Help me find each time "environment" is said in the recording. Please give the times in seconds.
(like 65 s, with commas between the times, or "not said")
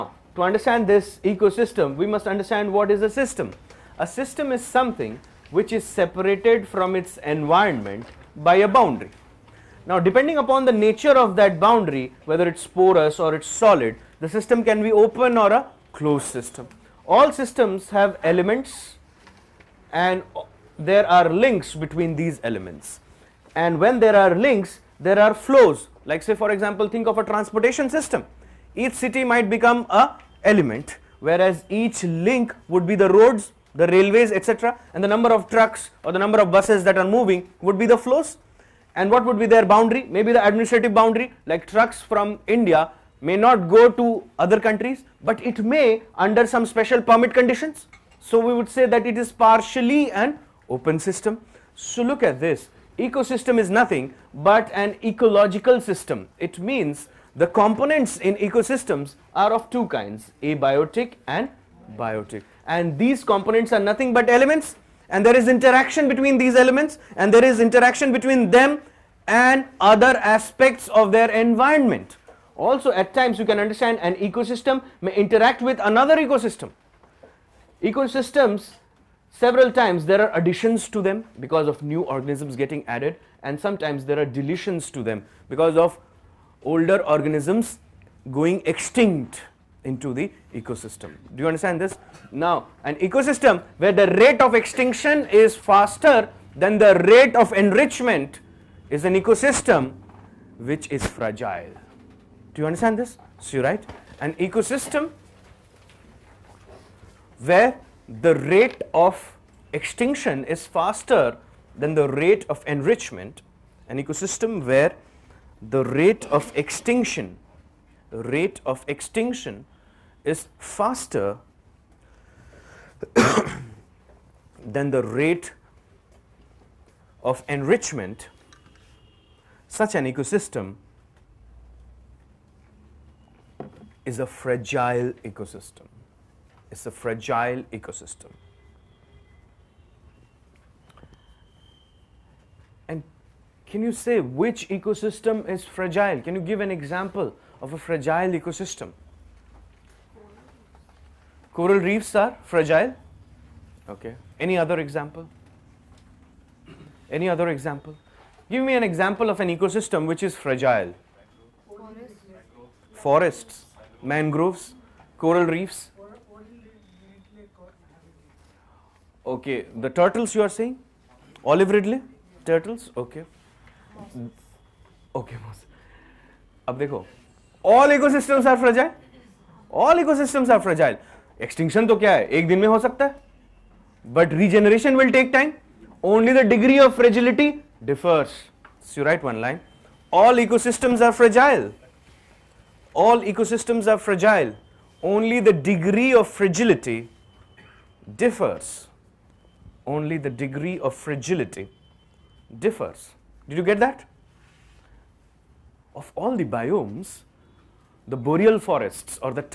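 7 s, 71 s.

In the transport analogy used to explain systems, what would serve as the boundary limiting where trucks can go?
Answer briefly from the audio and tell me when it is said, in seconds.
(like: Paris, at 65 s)
Administrative boundary, at 40 s.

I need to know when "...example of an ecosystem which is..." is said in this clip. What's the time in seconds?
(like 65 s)
158 s.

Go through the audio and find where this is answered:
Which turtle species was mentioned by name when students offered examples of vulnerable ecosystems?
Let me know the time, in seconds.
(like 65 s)
171 s.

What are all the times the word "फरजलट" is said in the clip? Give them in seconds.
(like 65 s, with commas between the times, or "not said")
186 s, 196 s, 201 s.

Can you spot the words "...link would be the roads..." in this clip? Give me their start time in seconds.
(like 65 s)
32 s.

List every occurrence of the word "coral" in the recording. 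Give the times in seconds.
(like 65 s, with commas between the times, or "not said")
151 s, 165 s.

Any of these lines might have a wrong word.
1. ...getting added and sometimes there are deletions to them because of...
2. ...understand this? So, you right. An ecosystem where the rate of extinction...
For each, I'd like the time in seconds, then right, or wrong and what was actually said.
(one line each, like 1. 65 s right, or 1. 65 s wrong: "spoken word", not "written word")
1. 82 s right
2. 102 s right.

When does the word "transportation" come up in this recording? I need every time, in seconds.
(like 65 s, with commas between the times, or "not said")
27 s.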